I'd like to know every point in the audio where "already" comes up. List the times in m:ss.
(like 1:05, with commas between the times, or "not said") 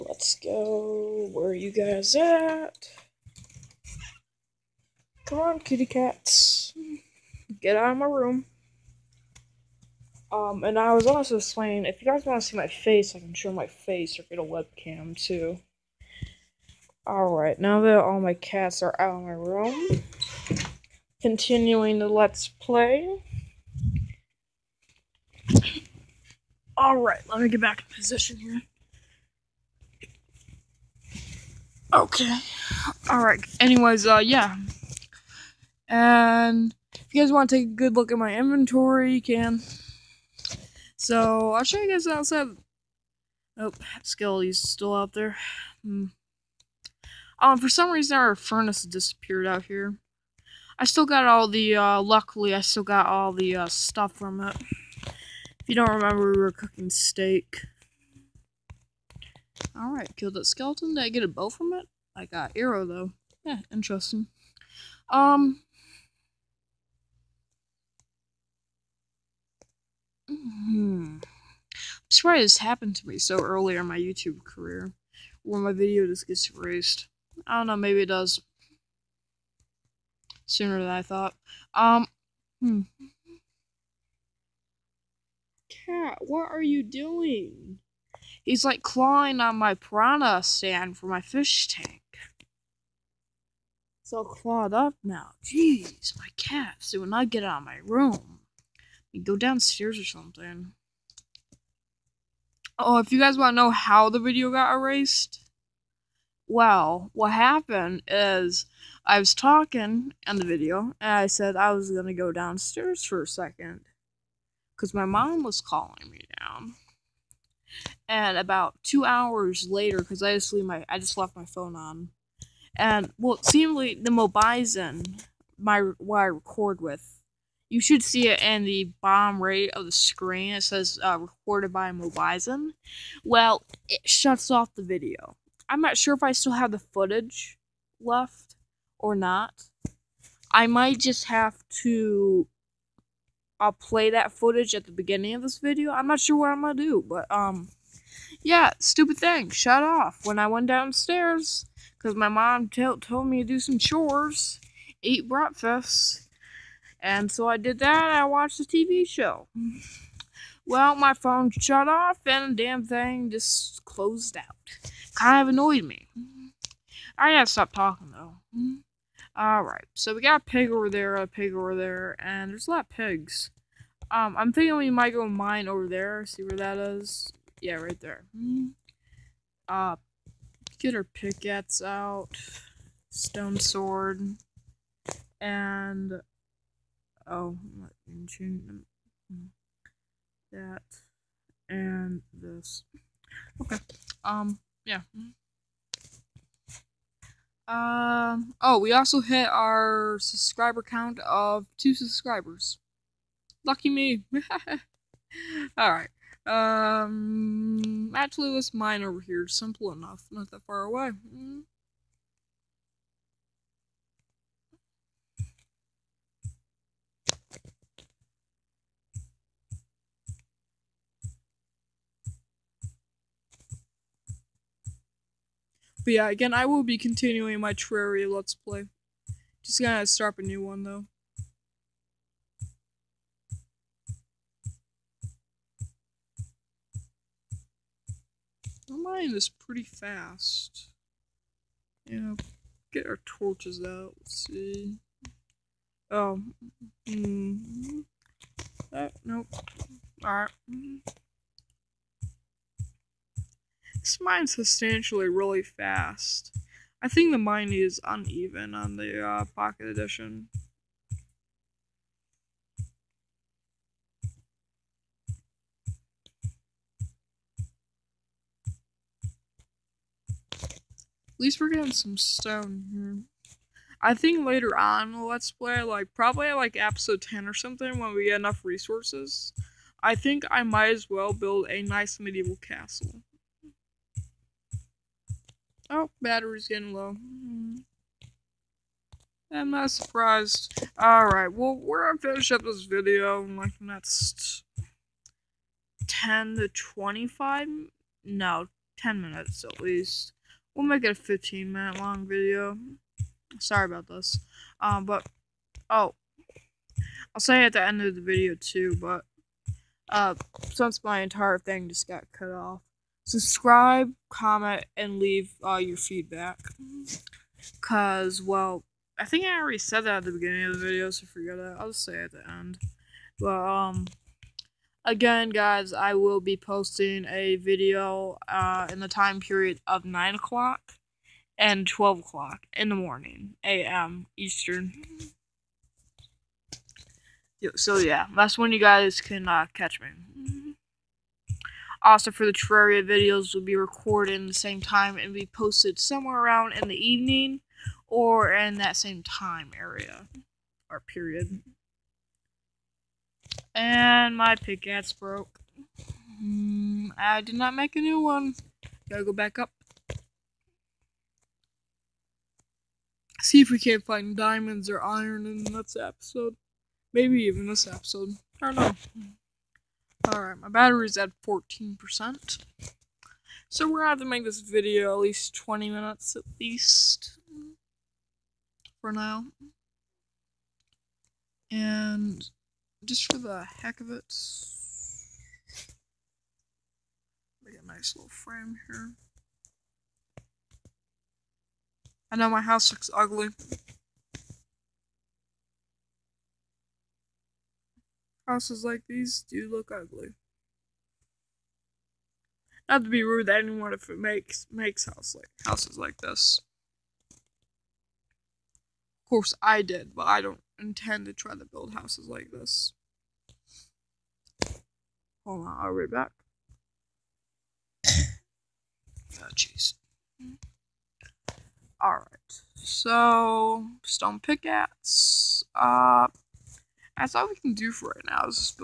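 5:19.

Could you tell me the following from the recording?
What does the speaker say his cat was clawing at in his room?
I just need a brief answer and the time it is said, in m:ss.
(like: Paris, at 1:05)
piranha stand, at 1:29.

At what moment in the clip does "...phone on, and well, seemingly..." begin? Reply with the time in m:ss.
2:01.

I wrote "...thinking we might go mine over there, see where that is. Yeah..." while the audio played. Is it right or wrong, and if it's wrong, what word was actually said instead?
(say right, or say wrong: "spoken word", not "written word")
right.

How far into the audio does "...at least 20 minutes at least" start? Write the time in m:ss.
6:15.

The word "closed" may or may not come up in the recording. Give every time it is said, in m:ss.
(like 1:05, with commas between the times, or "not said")
2:43.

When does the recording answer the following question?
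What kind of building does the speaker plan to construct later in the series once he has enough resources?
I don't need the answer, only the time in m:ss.
4:42.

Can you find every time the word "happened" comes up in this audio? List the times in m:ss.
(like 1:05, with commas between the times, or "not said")
1:12, 1:47.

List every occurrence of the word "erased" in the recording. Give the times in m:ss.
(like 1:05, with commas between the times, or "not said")
1:16, 1:44.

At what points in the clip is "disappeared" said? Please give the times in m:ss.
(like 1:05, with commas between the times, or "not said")
0:48.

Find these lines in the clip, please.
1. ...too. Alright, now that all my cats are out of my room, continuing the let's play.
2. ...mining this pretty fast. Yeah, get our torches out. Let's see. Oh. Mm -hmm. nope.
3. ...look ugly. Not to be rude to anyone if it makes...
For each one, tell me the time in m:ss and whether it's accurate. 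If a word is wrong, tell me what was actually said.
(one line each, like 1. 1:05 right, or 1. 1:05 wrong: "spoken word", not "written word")
1. 0:15 right
2. 3:59 right
3. 6:39 right.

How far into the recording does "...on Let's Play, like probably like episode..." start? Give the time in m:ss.
4:34.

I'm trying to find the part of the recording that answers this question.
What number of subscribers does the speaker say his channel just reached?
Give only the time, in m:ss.
3:21.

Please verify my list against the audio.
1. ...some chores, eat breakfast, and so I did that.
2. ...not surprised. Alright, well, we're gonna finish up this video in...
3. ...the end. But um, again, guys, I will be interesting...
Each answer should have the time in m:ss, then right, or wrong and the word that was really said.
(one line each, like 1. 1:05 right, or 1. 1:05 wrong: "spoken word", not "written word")
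1. 2:33 right
2. 4:49 right
3. 5:22 wrong: "posting", not "interesting".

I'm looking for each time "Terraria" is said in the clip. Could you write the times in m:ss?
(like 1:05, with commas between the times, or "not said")
3:47, 5:42.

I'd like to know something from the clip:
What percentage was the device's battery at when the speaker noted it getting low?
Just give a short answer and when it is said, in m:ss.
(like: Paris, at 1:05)
14%, at 6:11.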